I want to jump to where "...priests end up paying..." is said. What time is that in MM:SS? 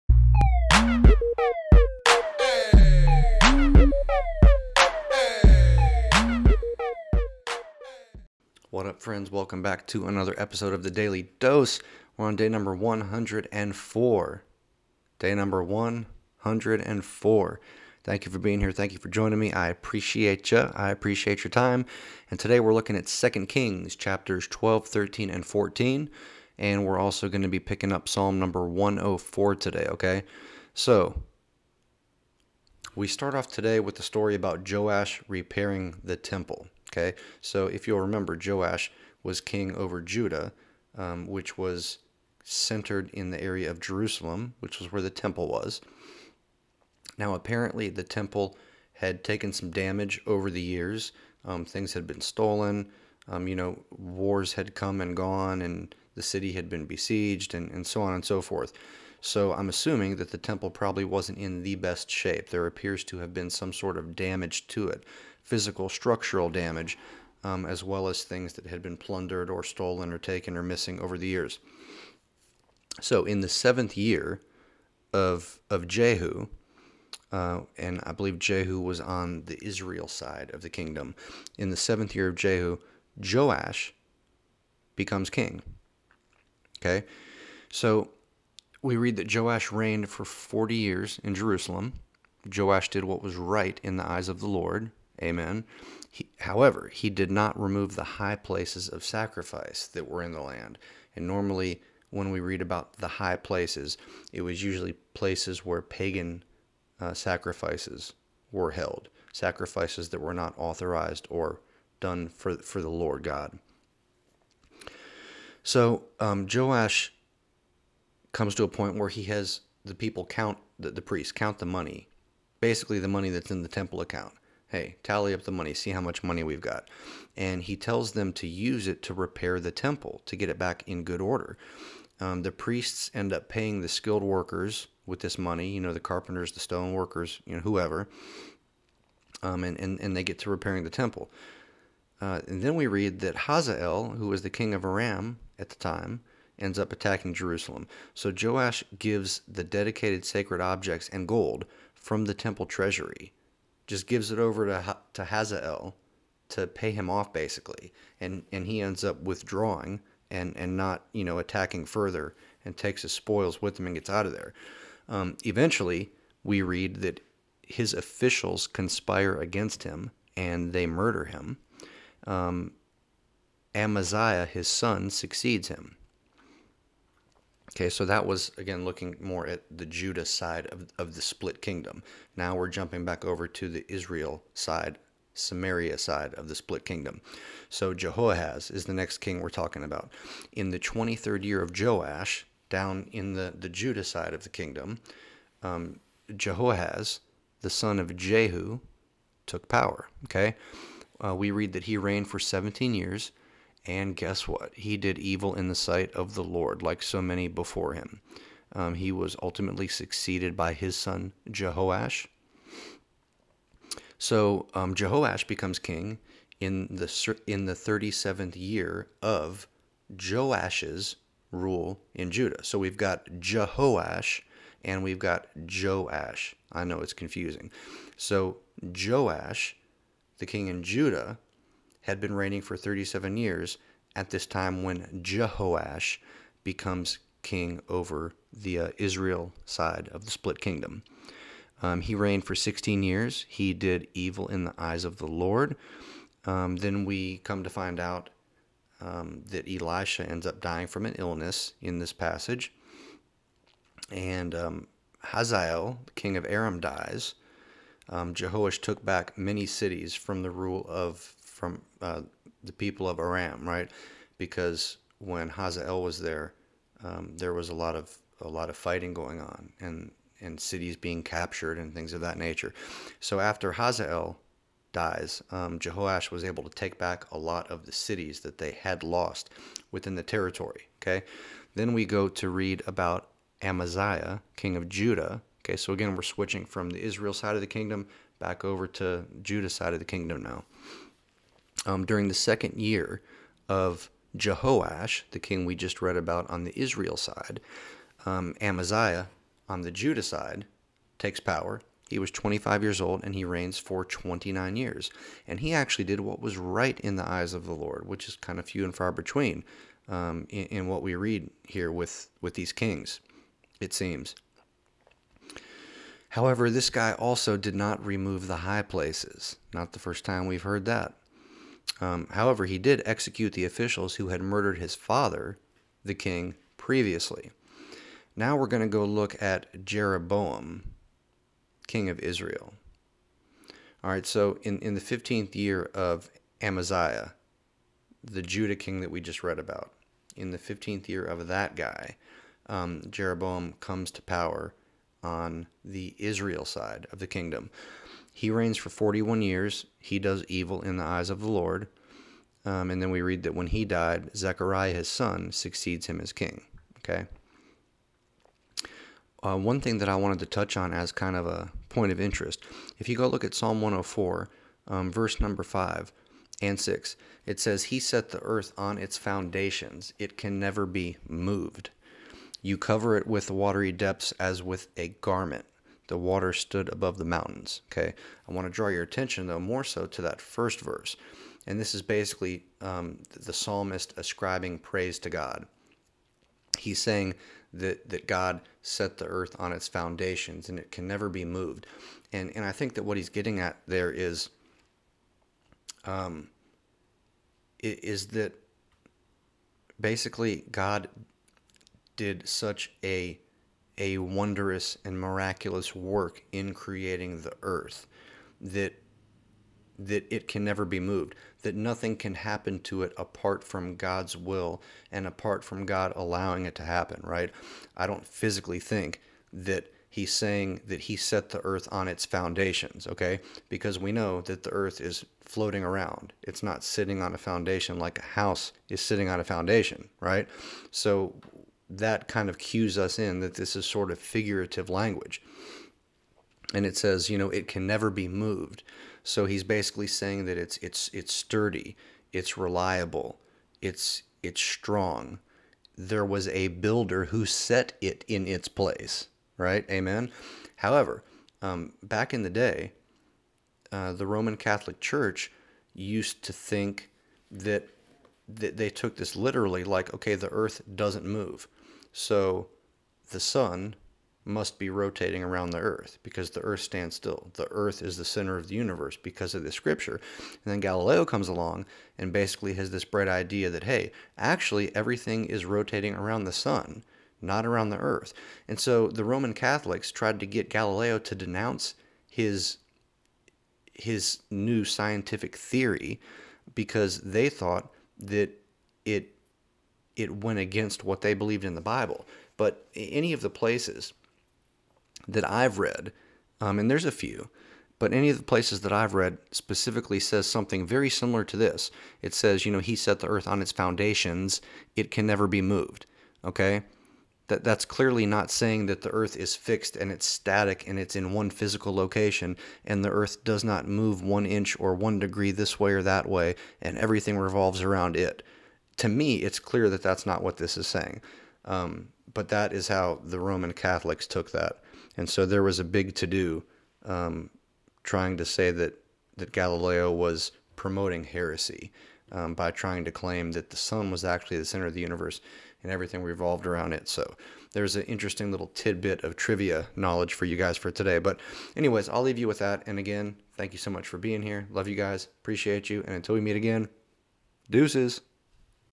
02:12.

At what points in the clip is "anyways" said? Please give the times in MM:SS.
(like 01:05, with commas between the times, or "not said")
09:01.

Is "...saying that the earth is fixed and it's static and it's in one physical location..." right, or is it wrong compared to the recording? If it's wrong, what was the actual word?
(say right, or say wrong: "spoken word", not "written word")
right.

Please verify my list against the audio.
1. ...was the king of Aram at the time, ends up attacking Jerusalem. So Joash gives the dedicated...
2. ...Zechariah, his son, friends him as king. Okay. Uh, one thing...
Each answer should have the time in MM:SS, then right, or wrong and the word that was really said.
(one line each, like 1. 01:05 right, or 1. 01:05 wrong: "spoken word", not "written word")
1. 02:24 right
2. 05:54 wrong: "succeeds", not "friends".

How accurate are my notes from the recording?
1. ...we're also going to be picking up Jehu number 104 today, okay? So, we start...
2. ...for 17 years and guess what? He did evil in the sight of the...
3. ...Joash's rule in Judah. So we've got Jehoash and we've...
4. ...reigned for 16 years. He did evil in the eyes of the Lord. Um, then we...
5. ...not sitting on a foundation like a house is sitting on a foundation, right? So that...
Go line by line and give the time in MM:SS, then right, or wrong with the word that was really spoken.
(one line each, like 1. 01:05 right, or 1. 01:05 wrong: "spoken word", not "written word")
1. 00:26 wrong: "Psalm", not "Jehu"
2. 03:22 right
3. 03:40 right
4. 04:02 right
5. 07:06 right.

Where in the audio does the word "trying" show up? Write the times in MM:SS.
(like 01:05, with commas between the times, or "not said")
08:48, 08:52.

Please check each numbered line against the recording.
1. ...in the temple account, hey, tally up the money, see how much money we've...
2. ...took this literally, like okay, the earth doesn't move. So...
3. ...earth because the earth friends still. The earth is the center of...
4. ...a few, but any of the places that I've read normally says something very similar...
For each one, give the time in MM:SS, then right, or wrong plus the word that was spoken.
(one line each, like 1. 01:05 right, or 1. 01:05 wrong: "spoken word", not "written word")
1. 02:03 right
2. 07:38 right
3. 07:45 wrong: "stands", not "friends"
4. 08:17 wrong: "specifically", not "normally".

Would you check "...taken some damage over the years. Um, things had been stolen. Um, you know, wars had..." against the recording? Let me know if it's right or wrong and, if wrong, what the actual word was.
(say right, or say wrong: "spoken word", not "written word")
right.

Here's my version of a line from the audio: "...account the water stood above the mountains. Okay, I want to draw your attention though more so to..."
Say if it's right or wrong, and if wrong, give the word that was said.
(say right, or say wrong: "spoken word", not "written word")
wrong: "garment", not "account".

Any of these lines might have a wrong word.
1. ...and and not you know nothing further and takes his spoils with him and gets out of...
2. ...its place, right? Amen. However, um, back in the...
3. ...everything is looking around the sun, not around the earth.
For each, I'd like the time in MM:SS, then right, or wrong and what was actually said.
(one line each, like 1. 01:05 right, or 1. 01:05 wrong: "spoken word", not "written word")
1. 02:40 wrong: "attacking", not "nothing"
2. 07:28 right
3. 07:54 wrong: "rotating", not "looking".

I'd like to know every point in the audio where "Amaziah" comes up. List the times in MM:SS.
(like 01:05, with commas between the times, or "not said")
02:53, 04:43, 04:58, 05:36.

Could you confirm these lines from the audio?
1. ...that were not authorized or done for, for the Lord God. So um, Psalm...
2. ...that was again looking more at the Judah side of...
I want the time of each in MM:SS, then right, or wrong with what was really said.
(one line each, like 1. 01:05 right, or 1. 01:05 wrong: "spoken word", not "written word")
1. 01:50 wrong: "Joash", not "Psalm"
2. 02:58 right.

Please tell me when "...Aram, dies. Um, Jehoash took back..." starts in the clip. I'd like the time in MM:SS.
04:16.